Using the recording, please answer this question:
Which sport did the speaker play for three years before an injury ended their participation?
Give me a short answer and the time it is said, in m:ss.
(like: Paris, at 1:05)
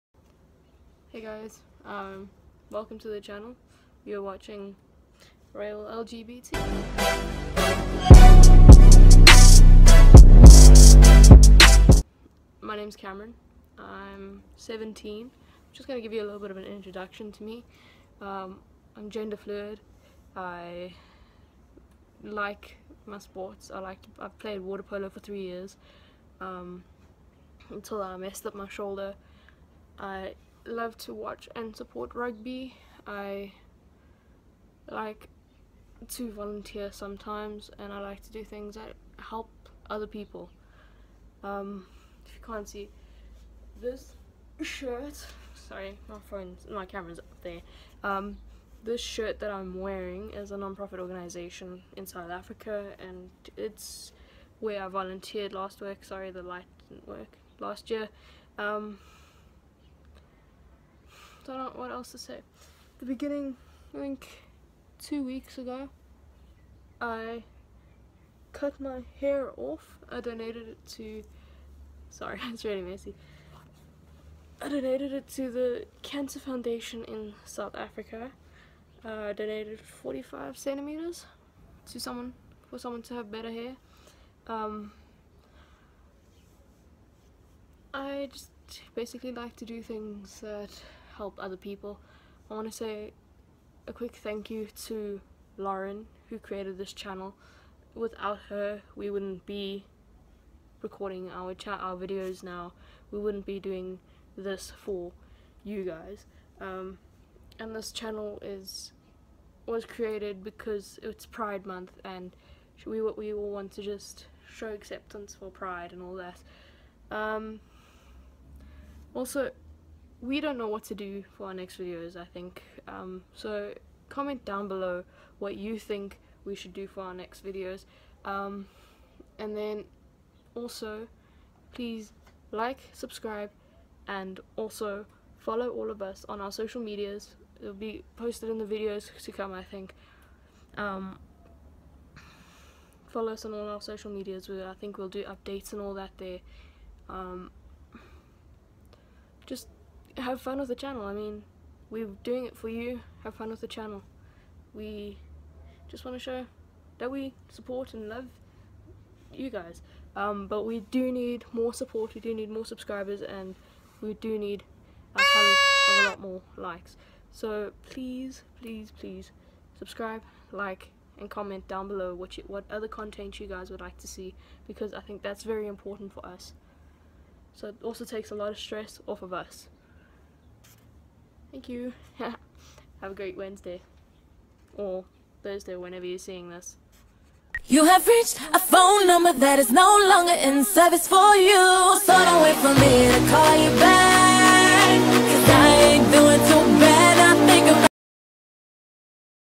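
Water polo, at 0:24.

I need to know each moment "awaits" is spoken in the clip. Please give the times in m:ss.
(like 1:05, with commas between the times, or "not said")
not said.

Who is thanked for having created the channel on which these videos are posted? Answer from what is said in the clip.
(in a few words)
Lauren.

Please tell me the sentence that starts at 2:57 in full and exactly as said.
So it also takes a lot of stress off of us.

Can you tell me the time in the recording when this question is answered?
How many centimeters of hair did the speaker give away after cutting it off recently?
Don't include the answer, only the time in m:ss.
1:19.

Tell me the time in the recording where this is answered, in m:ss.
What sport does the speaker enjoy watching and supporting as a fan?
0:32.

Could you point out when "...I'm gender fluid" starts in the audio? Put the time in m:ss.
0:18.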